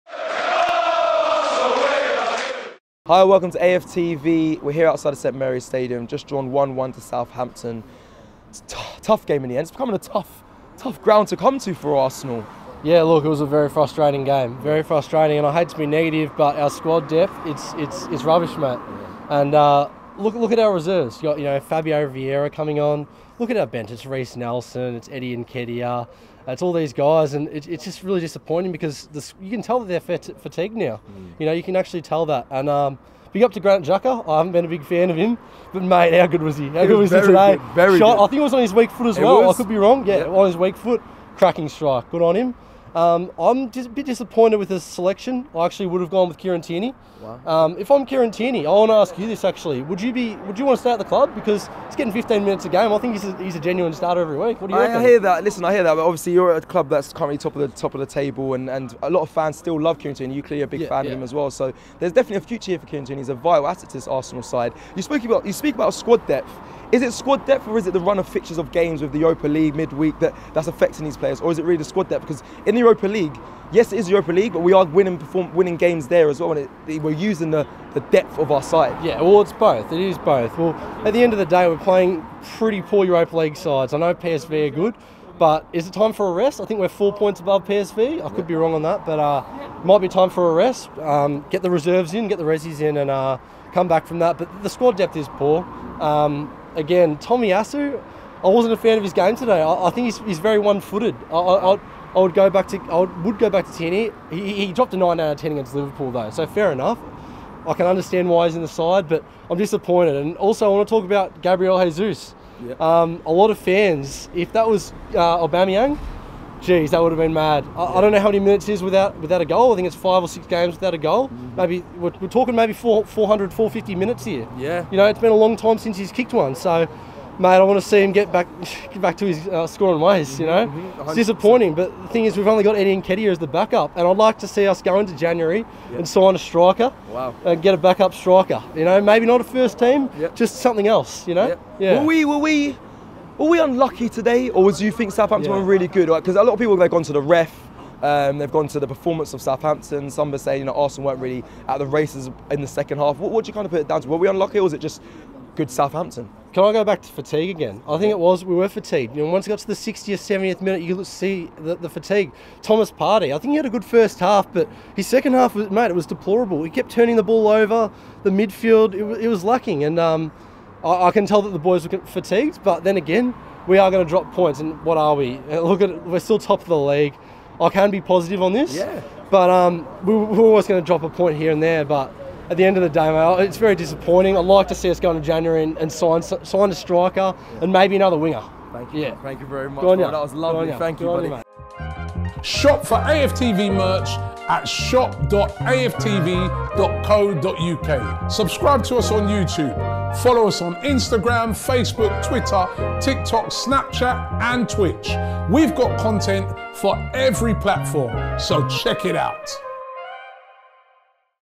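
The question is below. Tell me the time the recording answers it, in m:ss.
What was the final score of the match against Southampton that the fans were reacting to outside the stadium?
0:06.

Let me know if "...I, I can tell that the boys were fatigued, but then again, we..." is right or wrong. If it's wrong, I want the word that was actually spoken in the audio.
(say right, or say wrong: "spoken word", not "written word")
right.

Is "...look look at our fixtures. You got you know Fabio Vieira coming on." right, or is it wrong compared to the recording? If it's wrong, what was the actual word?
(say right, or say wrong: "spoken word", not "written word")
wrong: "reserves", not "fixtures".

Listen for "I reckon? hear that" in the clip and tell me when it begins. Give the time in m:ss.
0:54.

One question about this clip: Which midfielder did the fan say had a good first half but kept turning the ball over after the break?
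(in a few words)
Thomas Partey.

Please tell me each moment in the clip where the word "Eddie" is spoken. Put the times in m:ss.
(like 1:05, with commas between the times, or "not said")
0:25, 2:12.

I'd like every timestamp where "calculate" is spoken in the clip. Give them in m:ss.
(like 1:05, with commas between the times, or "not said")
not said.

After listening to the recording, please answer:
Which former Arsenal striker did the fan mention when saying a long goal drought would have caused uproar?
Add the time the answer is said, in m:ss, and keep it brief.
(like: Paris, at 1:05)
Aubameyang, at 1:55.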